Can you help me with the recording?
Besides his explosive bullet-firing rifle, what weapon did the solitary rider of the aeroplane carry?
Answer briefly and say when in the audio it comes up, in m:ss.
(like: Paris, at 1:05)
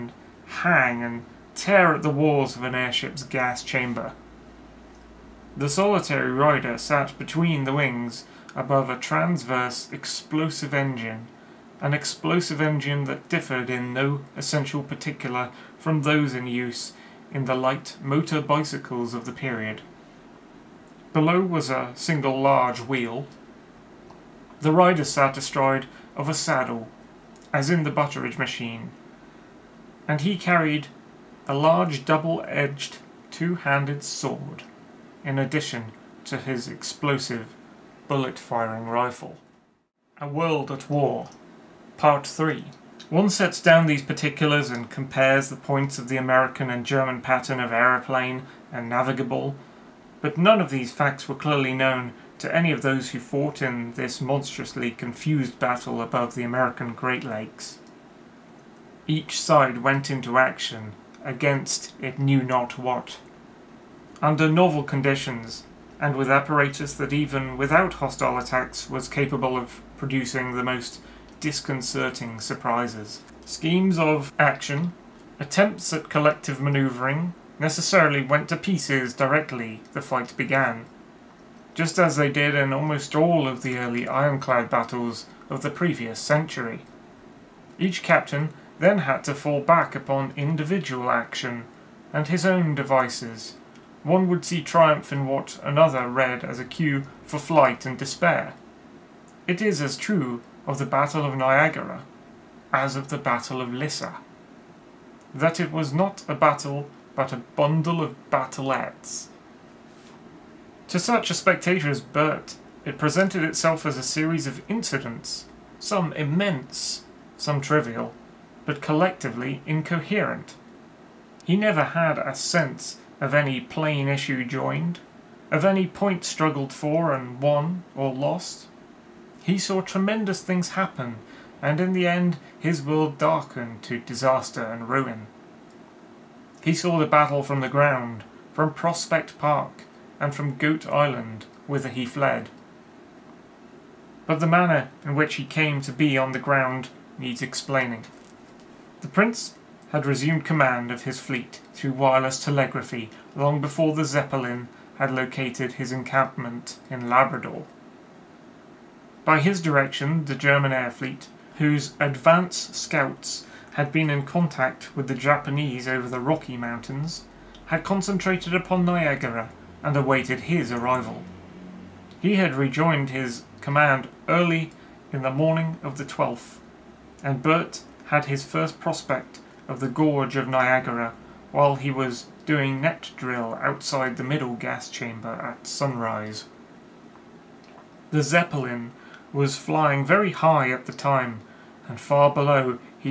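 double-edged two-handed sword, at 0:32.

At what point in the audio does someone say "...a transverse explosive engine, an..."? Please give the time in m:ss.
0:08.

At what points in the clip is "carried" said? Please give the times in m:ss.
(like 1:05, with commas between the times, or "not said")
0:30.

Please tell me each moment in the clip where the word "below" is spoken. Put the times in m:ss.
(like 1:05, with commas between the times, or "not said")
0:21, 3:12.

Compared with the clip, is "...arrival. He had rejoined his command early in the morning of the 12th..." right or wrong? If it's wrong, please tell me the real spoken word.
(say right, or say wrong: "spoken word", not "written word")
right.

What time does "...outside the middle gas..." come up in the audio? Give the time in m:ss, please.
3:03.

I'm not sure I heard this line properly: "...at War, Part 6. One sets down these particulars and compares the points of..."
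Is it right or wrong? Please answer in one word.
wrong.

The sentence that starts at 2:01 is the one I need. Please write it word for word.
He never had a sense of any plain issue joined, of any point struggled for and won or lost.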